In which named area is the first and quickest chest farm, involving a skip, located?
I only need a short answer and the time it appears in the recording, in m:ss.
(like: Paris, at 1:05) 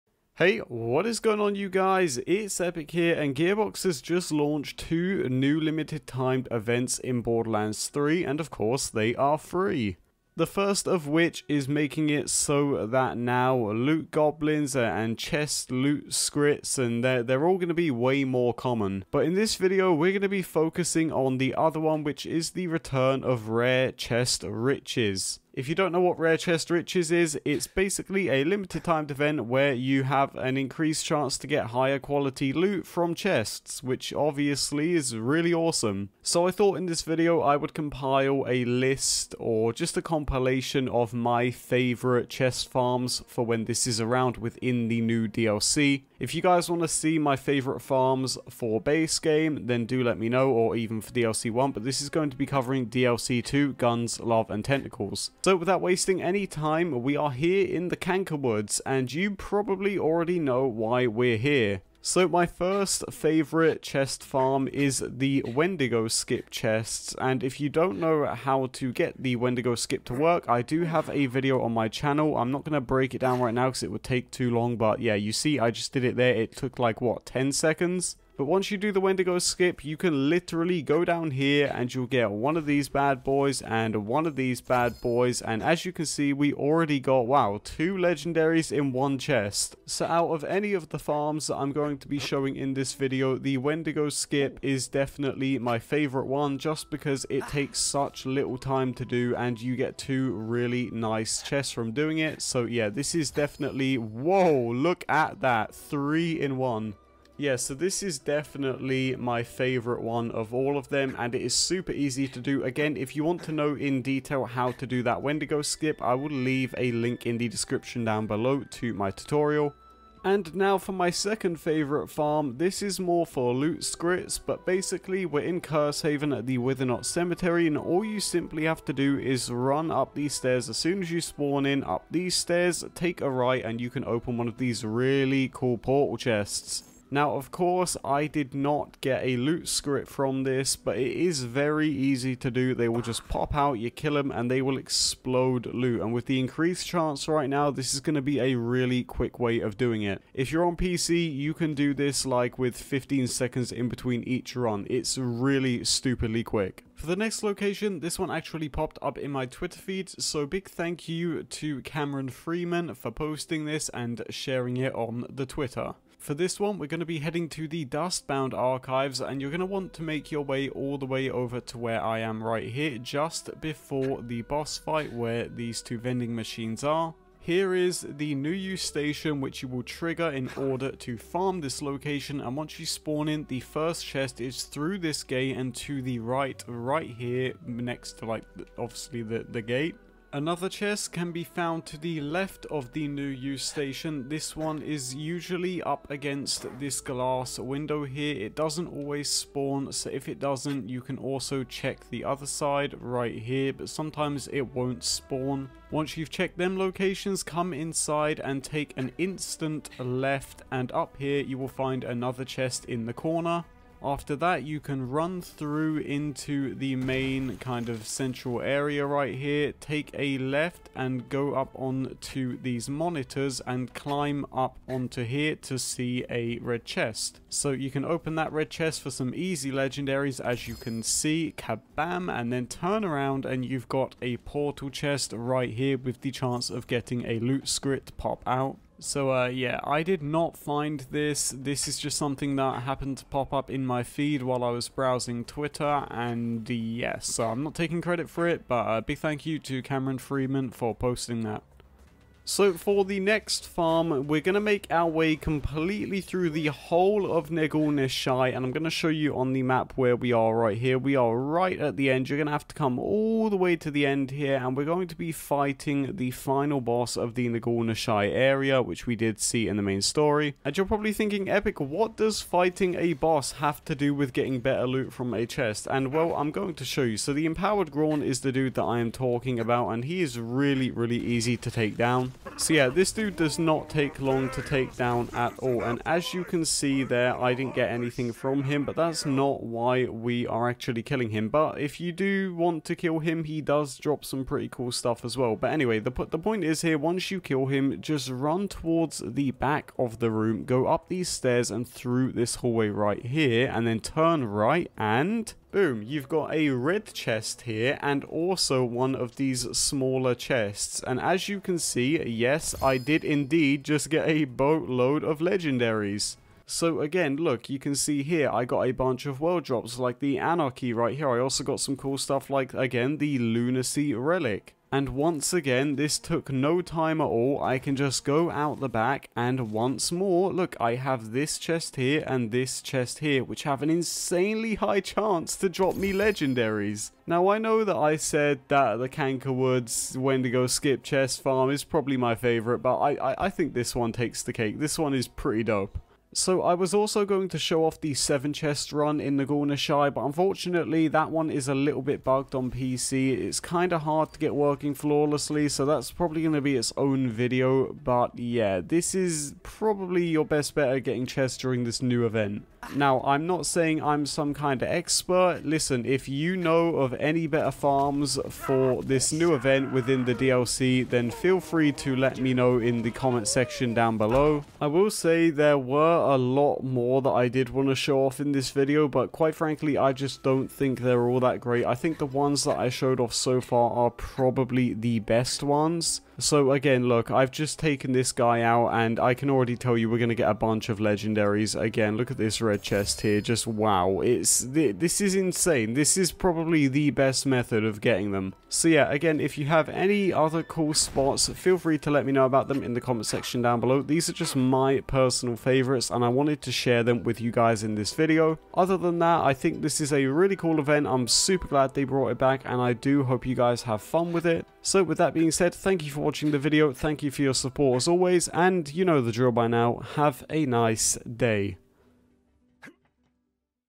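Canker Woods, at 0:57.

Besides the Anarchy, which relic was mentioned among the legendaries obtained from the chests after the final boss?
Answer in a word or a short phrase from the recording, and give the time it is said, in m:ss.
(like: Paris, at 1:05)
Lunacy, at 5:23.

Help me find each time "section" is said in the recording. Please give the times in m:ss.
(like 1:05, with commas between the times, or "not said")
6:13, 6:43.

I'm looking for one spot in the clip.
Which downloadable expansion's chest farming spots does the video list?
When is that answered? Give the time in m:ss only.
0:53.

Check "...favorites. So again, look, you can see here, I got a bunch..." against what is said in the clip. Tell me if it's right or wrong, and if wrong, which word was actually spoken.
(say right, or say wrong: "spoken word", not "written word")
wrong: "legendaries", not "favorites".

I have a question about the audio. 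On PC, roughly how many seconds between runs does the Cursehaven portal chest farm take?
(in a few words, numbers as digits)
15.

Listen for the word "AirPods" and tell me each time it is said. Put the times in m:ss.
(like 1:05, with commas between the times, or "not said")
not said.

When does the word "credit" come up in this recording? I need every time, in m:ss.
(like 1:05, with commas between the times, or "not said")
4:08.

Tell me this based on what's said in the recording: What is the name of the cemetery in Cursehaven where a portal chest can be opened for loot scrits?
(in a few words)
Withernot Cemetery.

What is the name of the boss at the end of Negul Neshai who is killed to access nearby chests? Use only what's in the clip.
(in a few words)
Empowered Grawn.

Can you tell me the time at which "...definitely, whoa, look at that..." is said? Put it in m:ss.
1:43.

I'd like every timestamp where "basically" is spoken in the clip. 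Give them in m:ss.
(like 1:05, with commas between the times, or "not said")
0:27, 2:04.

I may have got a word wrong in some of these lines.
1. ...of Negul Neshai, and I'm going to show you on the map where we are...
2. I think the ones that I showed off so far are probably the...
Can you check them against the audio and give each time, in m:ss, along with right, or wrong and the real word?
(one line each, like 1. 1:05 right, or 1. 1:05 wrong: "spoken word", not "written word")
1. 4:17 right
2. 6:21 right.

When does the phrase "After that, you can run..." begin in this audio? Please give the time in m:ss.
3:34.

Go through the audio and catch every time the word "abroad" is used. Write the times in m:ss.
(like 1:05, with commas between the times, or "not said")
not said.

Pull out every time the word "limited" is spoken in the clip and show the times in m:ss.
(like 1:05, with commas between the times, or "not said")
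0:05, 0:28.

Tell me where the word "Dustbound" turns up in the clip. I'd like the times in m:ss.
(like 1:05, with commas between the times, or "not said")
2:47.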